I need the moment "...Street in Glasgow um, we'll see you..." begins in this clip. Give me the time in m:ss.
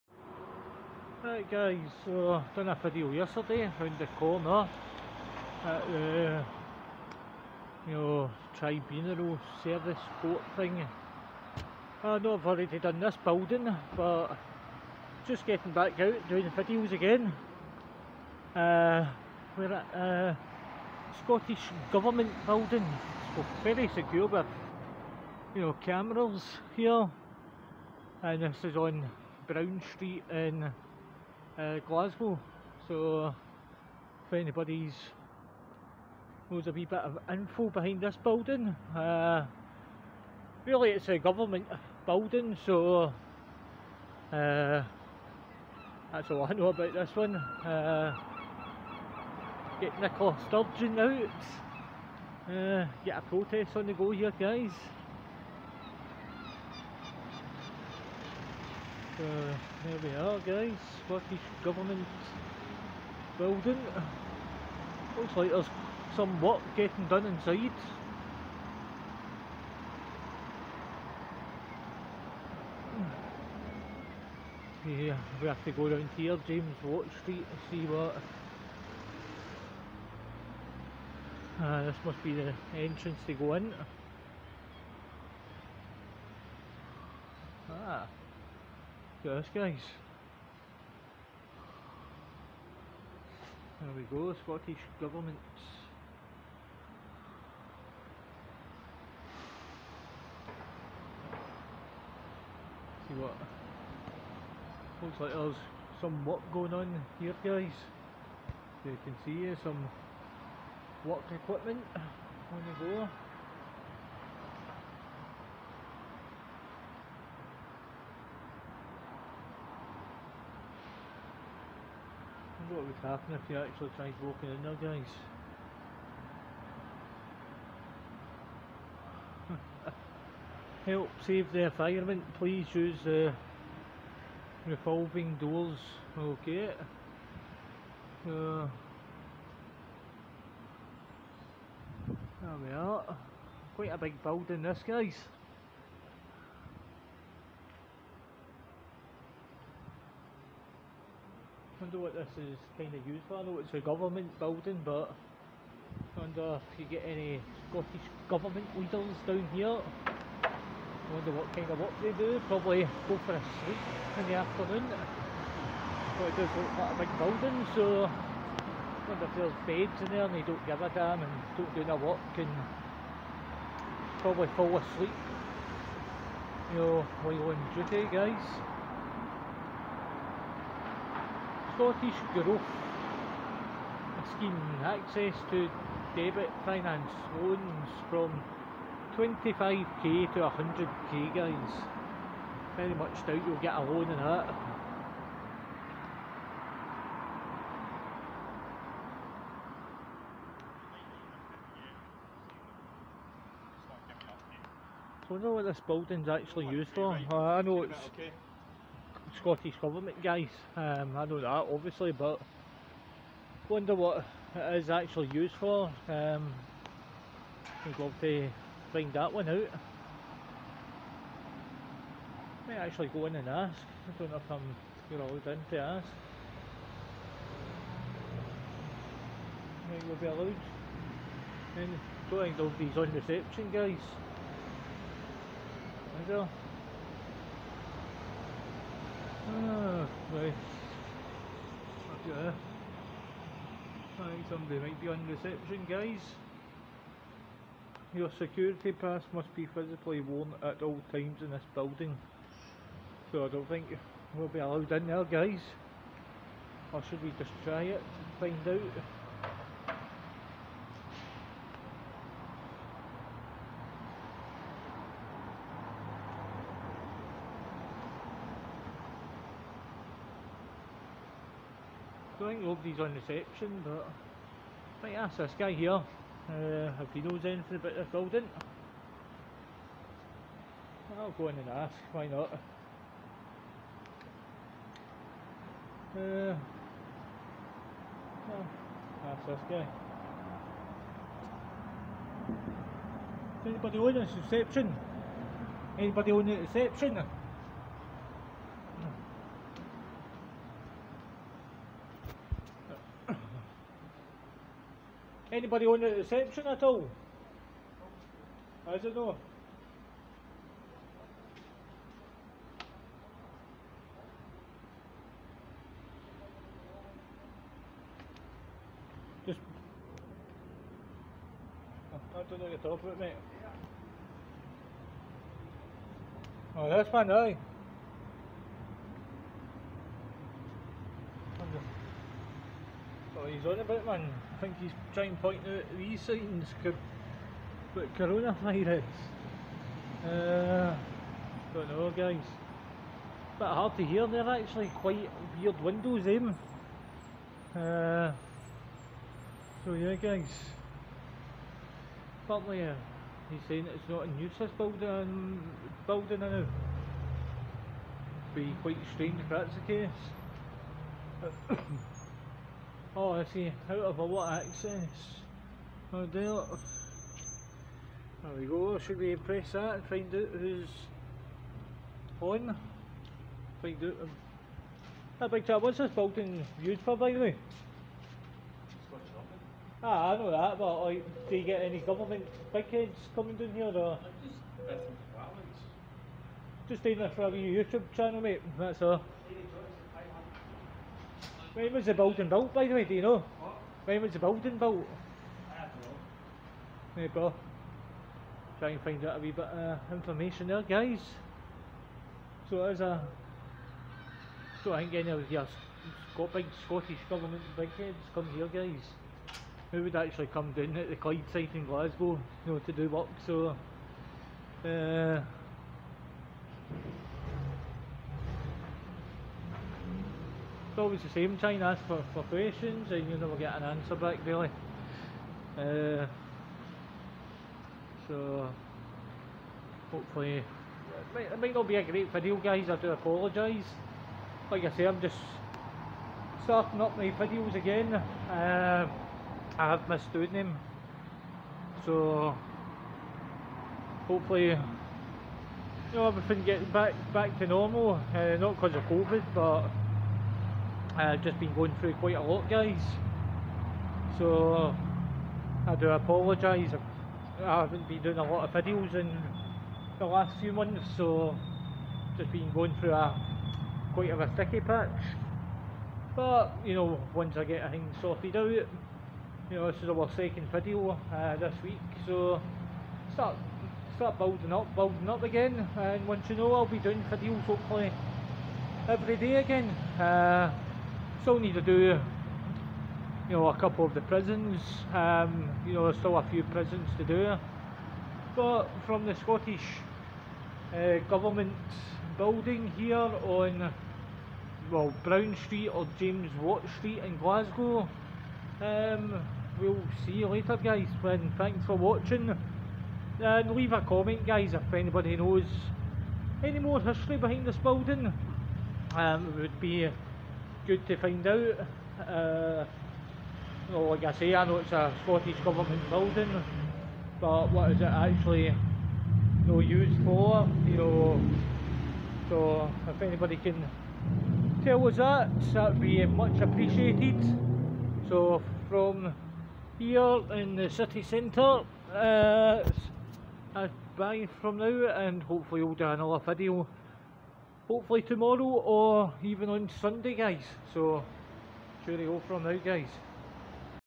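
8:16.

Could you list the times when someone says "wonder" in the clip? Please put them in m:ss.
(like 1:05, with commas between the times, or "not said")
2:31, 2:36, 2:41, 2:49, 3:33.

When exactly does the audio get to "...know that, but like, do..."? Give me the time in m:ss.
6:20.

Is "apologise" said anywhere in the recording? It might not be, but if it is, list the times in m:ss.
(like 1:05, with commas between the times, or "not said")
7:13, 7:36.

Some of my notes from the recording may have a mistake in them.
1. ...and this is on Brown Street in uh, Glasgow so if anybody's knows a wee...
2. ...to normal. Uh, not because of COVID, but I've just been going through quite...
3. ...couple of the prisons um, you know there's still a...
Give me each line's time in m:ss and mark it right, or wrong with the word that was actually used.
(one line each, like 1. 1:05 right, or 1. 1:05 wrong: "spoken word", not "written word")
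1. 0:28 right
2. 7:27 right
3. 8:03 right.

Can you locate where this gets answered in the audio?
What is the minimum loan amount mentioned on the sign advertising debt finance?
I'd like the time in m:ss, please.
3:09.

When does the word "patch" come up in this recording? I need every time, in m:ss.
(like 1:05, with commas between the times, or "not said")
7:44.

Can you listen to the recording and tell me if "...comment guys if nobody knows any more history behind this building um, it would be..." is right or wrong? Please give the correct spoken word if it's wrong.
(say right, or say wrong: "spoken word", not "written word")
wrong: "anybody", not "nobody".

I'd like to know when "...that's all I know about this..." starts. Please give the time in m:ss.
0:46.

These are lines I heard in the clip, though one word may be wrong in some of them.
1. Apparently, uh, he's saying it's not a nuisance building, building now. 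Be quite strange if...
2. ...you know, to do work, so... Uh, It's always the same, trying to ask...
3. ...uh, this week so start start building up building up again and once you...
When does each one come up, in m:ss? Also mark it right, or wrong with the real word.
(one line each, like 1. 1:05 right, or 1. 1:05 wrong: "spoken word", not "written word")
1. 5:52 right
2. 6:52 right
3. 7:51 right.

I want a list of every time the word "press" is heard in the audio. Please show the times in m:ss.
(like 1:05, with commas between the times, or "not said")
6:09.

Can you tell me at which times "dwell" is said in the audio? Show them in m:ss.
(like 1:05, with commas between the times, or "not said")
not said.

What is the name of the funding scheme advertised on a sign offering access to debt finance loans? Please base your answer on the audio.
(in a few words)
Scottish Growth Scheme.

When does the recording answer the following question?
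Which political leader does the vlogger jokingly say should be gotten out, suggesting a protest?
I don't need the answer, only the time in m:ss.
0:50.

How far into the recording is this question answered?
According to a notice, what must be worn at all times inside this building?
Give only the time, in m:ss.
4:08.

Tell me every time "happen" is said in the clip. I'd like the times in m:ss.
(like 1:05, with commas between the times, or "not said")
2:03.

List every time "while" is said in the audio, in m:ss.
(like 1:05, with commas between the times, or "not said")
2:57.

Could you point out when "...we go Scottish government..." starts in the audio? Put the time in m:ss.
1:33.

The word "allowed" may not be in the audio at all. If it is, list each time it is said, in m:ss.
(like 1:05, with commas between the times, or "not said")
3:45, 3:50, 4:14.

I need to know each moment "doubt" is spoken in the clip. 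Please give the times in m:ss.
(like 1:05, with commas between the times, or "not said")
3:13.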